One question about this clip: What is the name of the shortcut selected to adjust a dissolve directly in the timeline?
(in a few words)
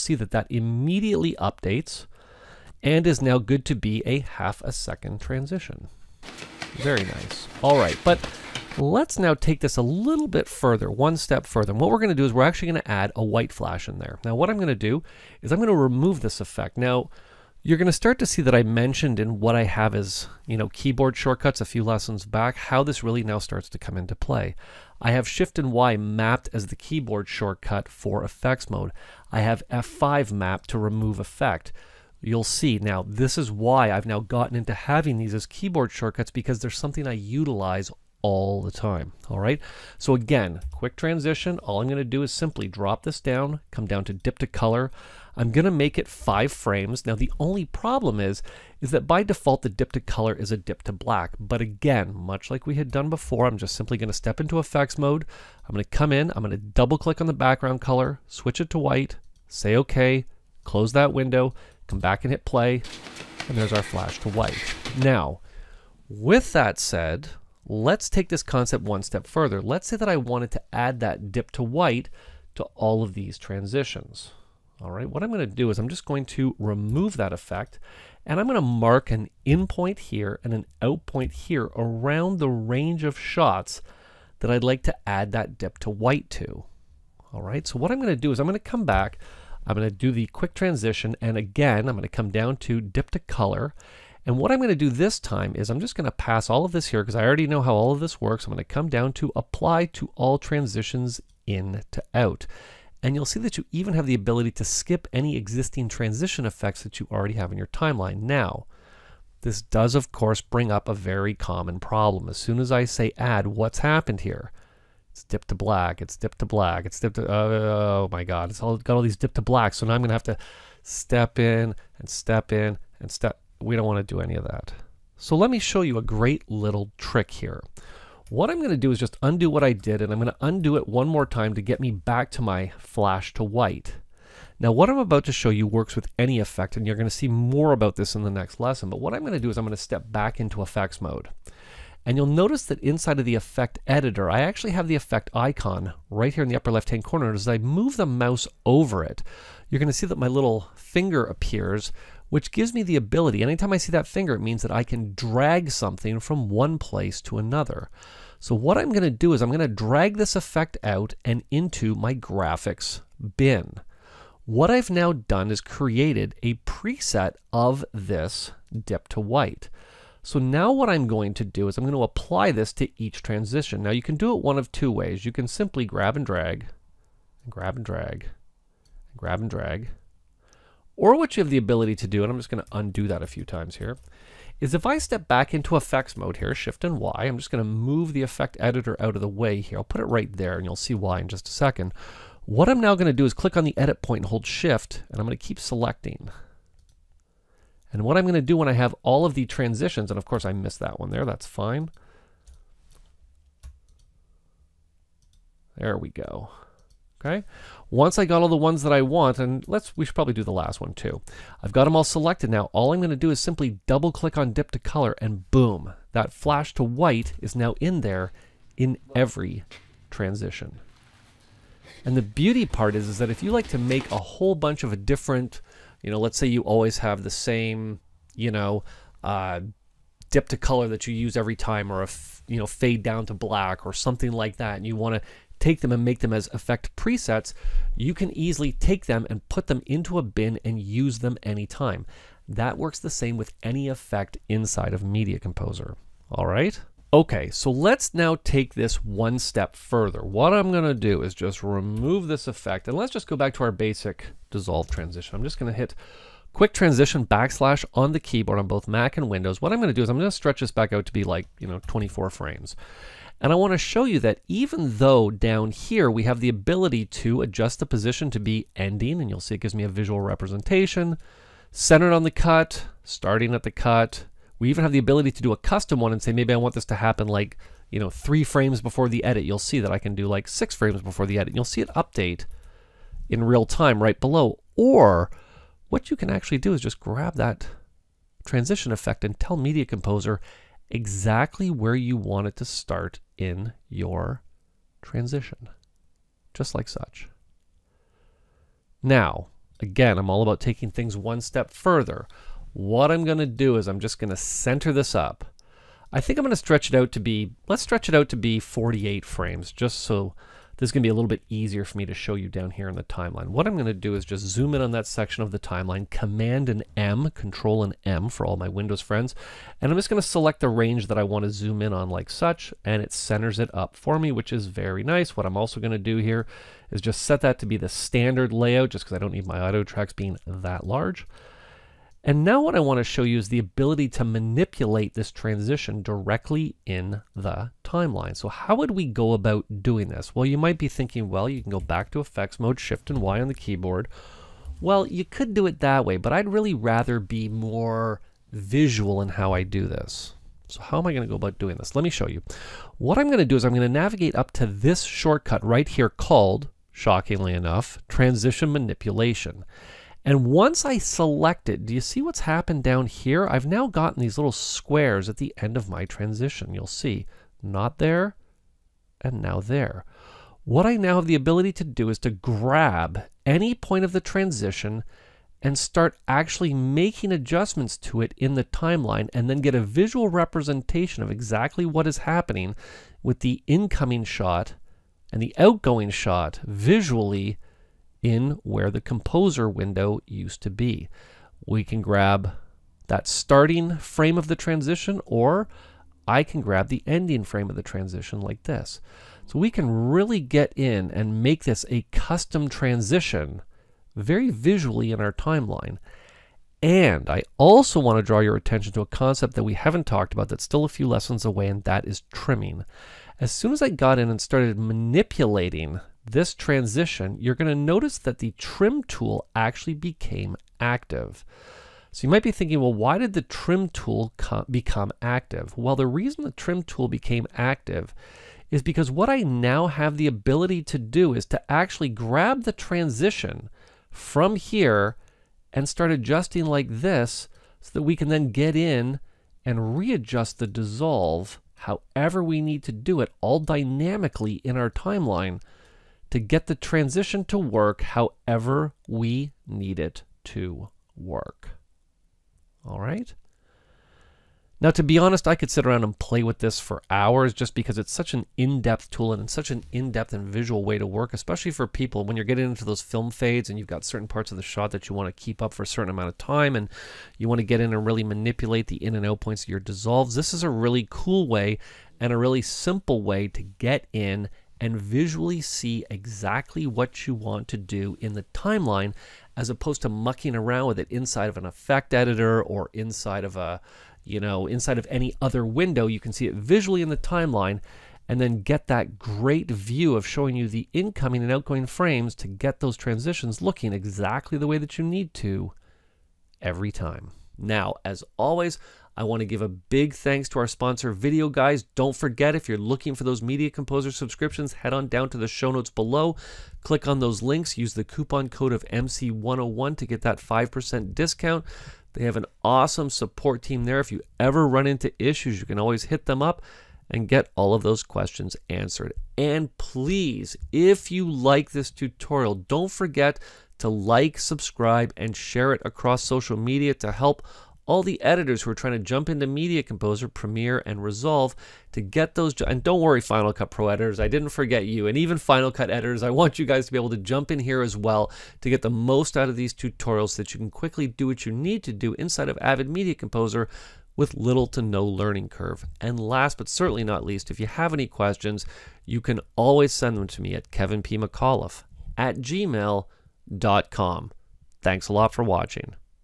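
Transition manipulation.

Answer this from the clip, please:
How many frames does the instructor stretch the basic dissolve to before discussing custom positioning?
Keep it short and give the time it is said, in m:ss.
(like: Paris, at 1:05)
24, at 4:21.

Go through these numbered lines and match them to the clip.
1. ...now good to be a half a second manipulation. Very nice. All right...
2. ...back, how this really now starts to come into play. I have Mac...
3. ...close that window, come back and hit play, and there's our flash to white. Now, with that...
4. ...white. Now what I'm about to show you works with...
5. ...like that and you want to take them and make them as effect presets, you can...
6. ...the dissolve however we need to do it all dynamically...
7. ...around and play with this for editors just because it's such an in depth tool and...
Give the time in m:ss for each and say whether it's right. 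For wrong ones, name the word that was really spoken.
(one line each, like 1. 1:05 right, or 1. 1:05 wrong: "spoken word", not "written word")
1. 0:03 wrong: "transition", not "manipulation"
2. 0:22 wrong: "Shift", not "Mac"
3. 1:00 right
4. 2:13 right
5. 3:54 right
6. 7:20 right
7. 7:35 wrong: "hours", not "editors".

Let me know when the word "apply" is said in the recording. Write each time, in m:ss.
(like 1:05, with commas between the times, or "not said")
1:39, 2:52.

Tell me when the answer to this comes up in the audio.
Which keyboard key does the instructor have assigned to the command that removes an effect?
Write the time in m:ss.
0:29.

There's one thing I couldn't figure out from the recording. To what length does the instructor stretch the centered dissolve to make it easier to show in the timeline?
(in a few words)
48 frames.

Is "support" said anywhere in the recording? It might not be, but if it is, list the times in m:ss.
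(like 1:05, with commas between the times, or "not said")
8:33.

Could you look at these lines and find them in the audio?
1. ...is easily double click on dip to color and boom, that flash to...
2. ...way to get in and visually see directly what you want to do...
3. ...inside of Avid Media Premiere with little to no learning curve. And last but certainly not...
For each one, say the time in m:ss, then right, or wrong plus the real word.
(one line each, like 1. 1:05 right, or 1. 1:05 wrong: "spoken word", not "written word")
1. 3:33 wrong: "simply", not "easily"
2. 7:53 wrong: "exactly", not "directly"
3. 9:02 wrong: "Composer", not "Premiere".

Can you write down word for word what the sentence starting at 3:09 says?
I'll put it right there and you'll see why in just a second.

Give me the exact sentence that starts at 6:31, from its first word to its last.
We can grab that starting frame of the transition or I can grab the ending frame of the transition like this.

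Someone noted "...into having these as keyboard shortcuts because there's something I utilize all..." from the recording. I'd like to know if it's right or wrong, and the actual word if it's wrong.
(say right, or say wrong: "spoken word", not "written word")
right.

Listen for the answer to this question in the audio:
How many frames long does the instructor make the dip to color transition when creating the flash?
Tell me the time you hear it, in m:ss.
0:46.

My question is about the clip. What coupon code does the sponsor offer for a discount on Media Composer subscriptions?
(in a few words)
MC101.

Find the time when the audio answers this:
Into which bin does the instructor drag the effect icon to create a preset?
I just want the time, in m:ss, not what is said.
2:42.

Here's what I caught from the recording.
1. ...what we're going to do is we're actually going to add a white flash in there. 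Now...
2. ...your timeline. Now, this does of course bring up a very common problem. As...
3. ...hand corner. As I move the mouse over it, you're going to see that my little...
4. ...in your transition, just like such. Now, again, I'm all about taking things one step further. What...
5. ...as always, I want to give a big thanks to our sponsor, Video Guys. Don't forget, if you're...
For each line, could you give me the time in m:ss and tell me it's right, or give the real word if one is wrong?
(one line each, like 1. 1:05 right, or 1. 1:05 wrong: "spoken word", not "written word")
1. 0:11 right
2. 1:47 right
3. 2:26 right
4. 4:53 right
5. 8:18 right.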